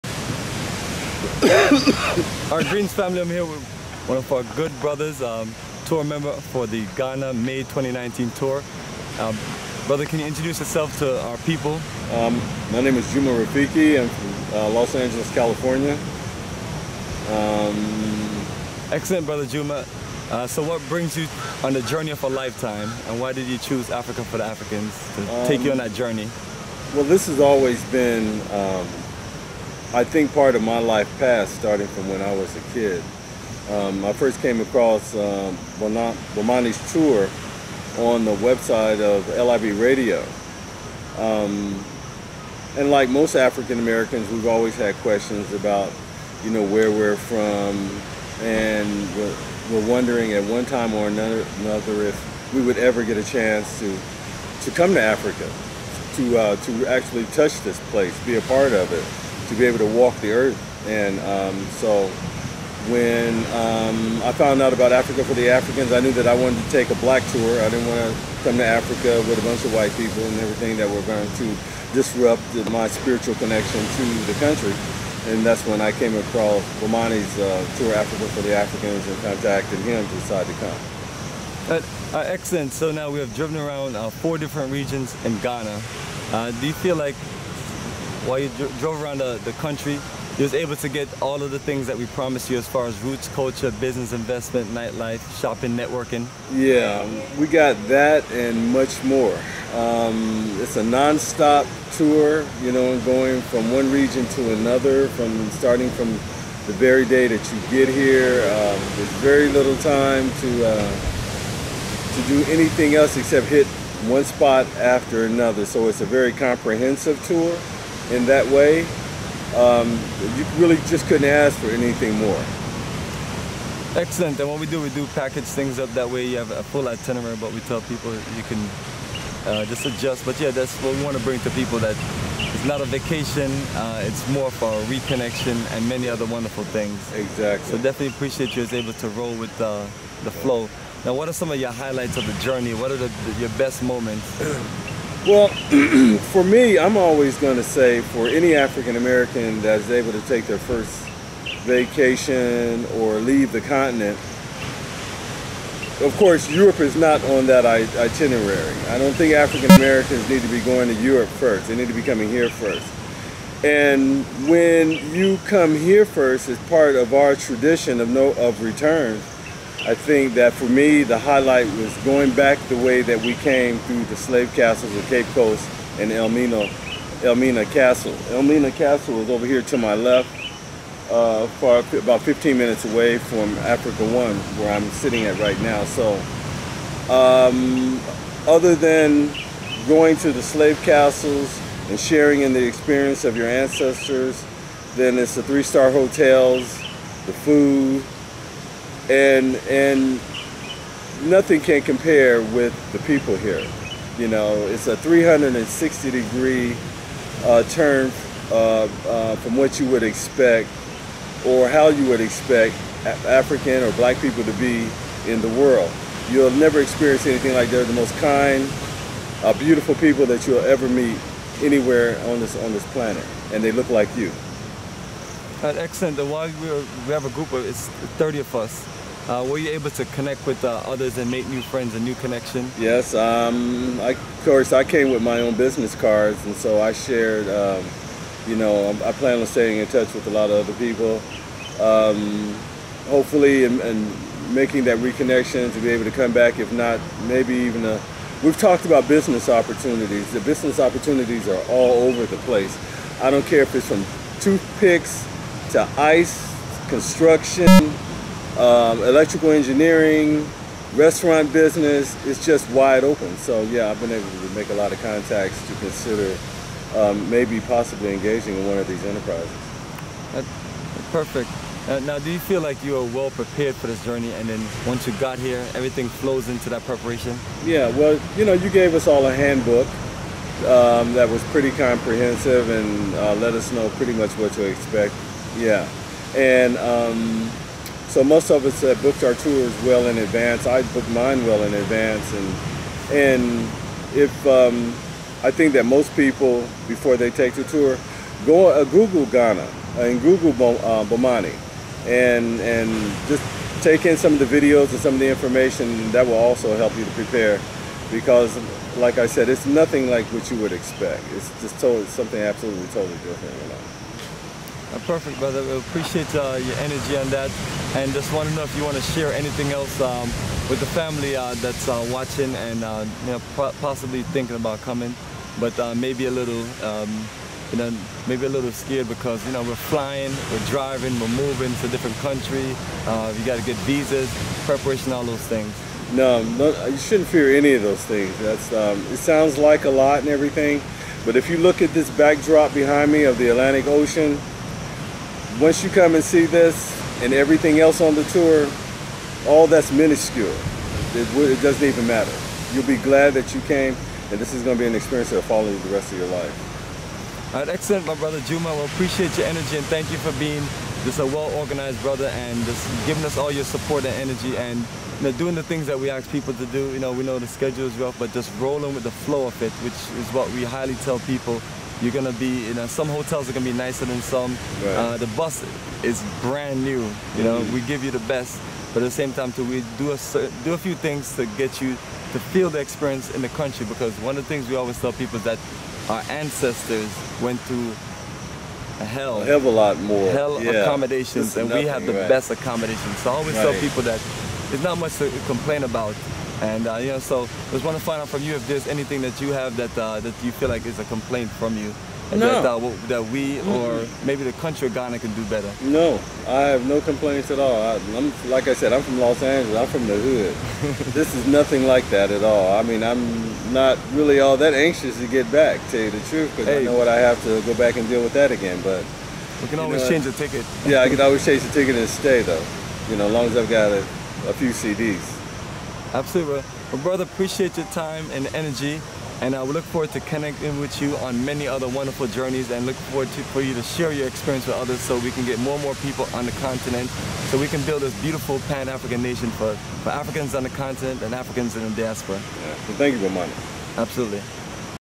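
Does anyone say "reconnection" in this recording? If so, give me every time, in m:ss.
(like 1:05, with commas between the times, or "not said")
2:14, 4:04.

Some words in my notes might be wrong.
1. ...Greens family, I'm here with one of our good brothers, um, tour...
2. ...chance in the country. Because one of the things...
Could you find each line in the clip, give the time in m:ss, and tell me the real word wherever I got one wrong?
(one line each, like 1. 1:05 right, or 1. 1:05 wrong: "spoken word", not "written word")
1. 0:02 right
2. 6:22 wrong: "experience", not "chance".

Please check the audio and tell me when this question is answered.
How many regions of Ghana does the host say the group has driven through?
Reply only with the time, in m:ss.
1:24.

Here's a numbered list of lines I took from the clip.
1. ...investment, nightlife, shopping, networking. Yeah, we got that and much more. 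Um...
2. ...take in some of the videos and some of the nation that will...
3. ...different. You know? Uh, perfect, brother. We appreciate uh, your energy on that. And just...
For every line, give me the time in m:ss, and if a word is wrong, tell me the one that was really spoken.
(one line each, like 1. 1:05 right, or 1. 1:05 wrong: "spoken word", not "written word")
1. 1:34 right
2. 5:03 wrong: "information", not "nation"
3. 5:13 right.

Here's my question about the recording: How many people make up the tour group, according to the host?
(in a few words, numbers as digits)
30.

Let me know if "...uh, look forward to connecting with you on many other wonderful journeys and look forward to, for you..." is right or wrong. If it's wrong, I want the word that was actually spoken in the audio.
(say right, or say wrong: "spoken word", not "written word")
right.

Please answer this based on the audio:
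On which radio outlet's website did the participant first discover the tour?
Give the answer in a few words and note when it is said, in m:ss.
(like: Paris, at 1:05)
LIB Radio, at 0:39.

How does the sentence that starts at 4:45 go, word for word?
Yeah, and um, so most of us have booked our tours well in advance.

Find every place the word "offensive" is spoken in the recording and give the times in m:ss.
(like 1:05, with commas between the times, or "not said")
not said.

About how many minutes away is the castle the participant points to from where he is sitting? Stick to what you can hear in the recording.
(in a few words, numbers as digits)
15.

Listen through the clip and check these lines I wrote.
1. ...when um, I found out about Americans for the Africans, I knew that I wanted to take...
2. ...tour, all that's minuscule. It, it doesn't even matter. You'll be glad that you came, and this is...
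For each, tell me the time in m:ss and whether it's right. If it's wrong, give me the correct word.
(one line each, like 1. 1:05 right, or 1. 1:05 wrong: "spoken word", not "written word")
1. 1:02 wrong: "Africa", not "Americans"
2. 5:48 right.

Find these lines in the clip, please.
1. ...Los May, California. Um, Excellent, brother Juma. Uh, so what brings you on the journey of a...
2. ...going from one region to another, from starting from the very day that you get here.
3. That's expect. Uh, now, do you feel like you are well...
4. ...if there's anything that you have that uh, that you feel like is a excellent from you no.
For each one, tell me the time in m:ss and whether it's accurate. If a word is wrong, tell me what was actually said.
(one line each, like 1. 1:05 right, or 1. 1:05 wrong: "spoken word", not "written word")
1. 0:14 wrong: "Angeles", not "May"
2. 1:43 right
3. 4:30 wrong: "perfect", not "expect"
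4. 6:38 wrong: "complaint", not "excellent".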